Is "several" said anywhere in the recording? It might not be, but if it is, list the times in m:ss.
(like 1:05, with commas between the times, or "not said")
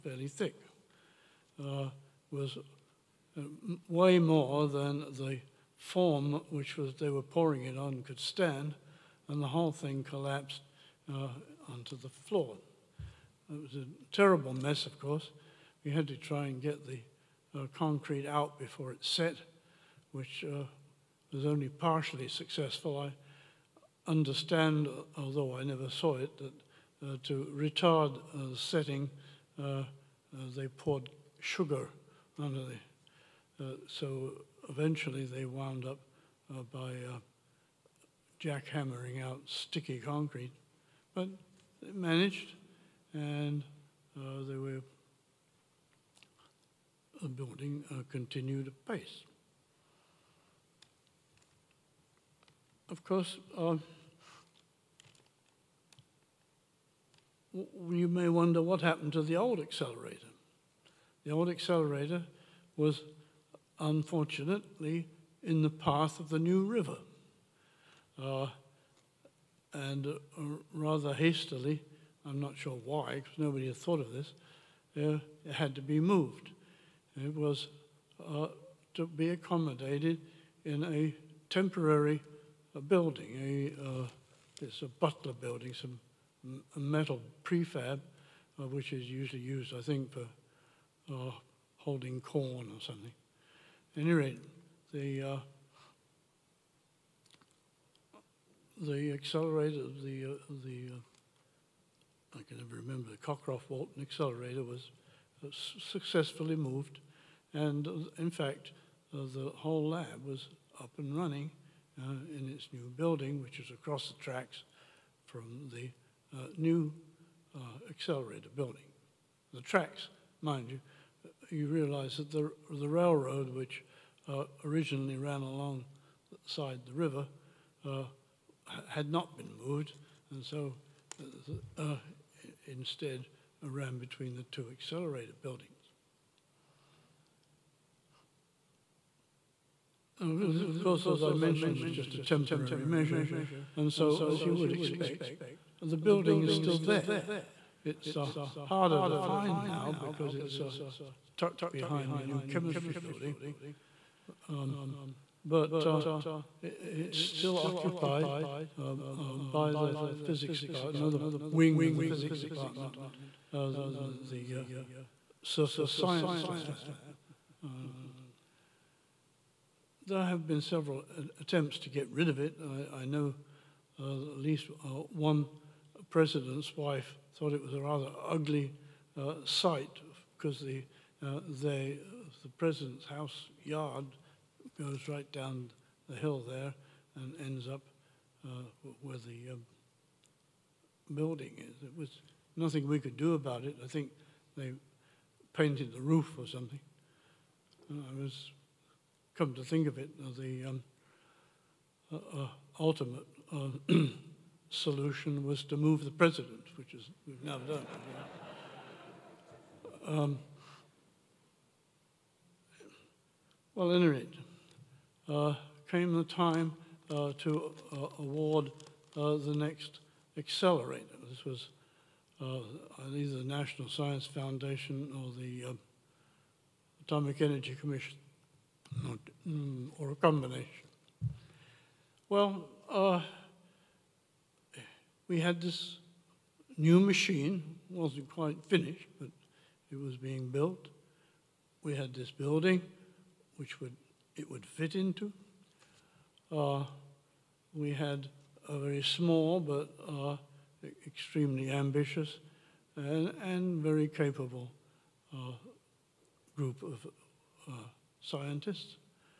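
2:50.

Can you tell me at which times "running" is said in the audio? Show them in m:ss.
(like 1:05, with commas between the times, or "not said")
1:51.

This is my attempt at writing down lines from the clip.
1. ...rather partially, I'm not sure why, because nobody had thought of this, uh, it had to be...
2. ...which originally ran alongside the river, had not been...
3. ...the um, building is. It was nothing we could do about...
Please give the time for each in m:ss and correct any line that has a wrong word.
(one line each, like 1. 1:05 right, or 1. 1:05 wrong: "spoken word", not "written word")
1. 1:10 wrong: "hastily", not "partially"
2. 2:03 right
3. 3:09 right.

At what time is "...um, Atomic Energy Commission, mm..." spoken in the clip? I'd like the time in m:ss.
3:45.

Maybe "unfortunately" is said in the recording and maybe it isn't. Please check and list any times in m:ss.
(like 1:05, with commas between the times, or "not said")
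1:03.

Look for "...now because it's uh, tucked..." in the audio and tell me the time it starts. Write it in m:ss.
2:29.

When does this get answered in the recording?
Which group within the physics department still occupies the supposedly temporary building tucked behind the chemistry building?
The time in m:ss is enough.
2:45.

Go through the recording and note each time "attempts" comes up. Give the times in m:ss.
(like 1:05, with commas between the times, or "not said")
2:51.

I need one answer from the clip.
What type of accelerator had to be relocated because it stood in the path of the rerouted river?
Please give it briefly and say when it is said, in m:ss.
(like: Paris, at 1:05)
Cockcroft Walton, at 1:43.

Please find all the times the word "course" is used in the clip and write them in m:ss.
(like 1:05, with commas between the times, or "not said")
0:14, 0:53, 2:20.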